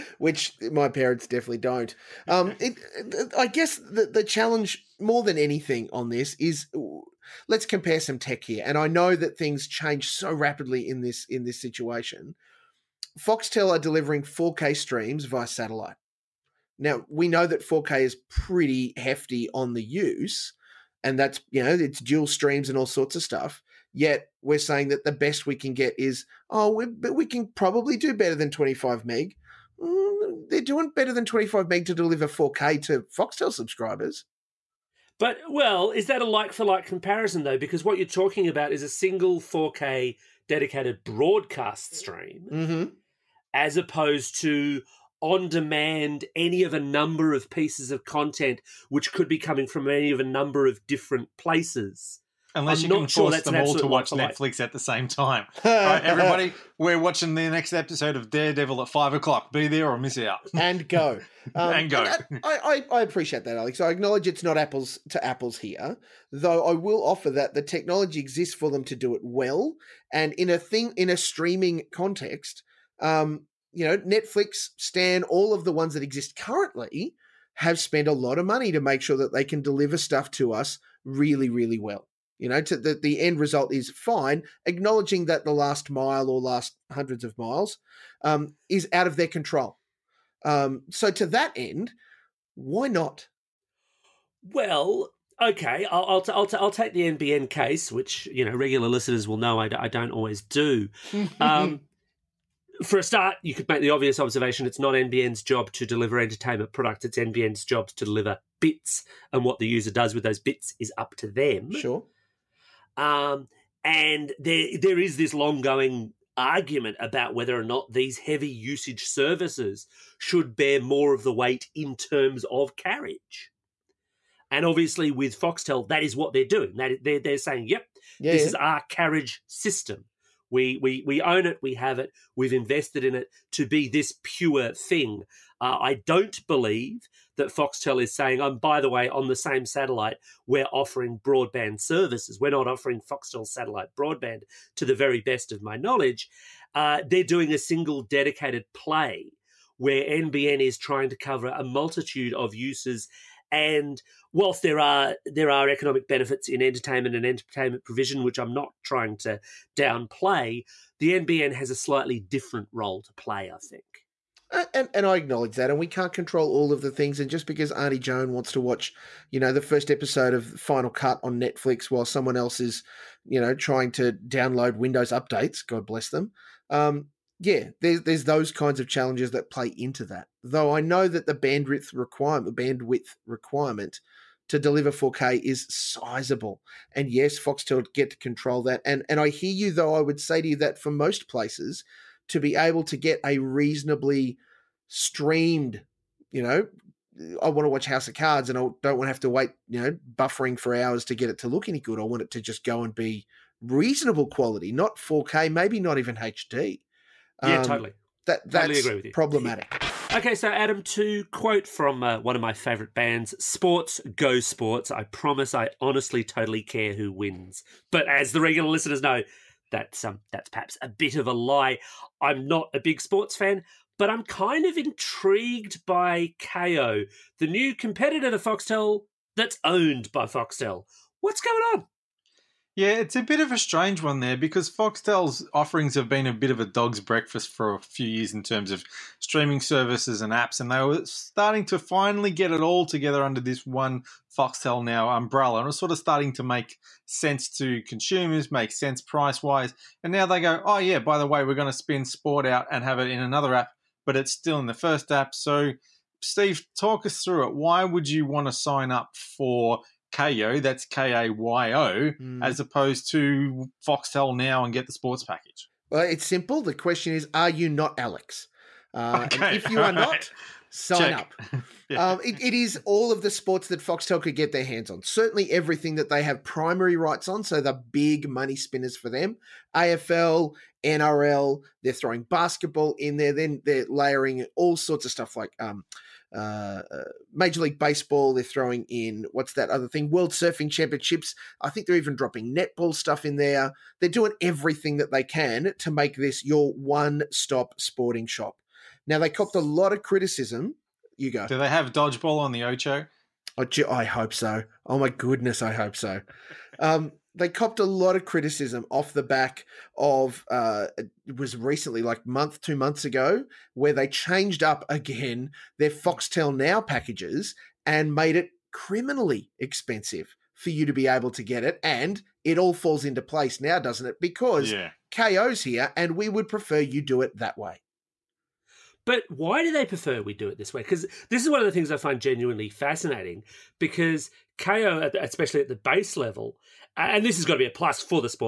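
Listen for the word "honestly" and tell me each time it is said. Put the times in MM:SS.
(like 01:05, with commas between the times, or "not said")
03:35.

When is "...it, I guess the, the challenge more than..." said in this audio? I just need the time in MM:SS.
00:02.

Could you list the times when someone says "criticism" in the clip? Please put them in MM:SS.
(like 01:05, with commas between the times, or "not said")
05:00, 05:08.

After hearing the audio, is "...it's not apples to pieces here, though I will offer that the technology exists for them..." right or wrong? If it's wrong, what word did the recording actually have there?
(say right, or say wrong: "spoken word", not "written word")
wrong: "apples", not "pieces".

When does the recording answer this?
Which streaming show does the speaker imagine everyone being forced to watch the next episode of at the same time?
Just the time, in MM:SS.
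00:58.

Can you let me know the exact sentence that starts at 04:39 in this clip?
AFL, NRL, they're throwing basketball in there.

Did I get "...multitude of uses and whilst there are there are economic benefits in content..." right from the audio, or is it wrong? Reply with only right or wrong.
wrong.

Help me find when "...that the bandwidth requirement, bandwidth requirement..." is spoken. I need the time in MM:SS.
03:01.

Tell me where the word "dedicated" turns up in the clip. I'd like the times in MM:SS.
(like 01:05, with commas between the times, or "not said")
00:40, 02:28.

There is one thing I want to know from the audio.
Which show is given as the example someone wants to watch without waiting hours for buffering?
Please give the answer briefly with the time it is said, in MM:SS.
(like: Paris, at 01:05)
House of Cards, at 03:17.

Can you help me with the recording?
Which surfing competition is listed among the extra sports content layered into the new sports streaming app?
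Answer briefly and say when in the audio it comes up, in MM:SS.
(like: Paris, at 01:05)
World Surfing Championships, at 04:50.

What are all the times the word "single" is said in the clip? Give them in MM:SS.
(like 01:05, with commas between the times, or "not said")
00:38, 02:27.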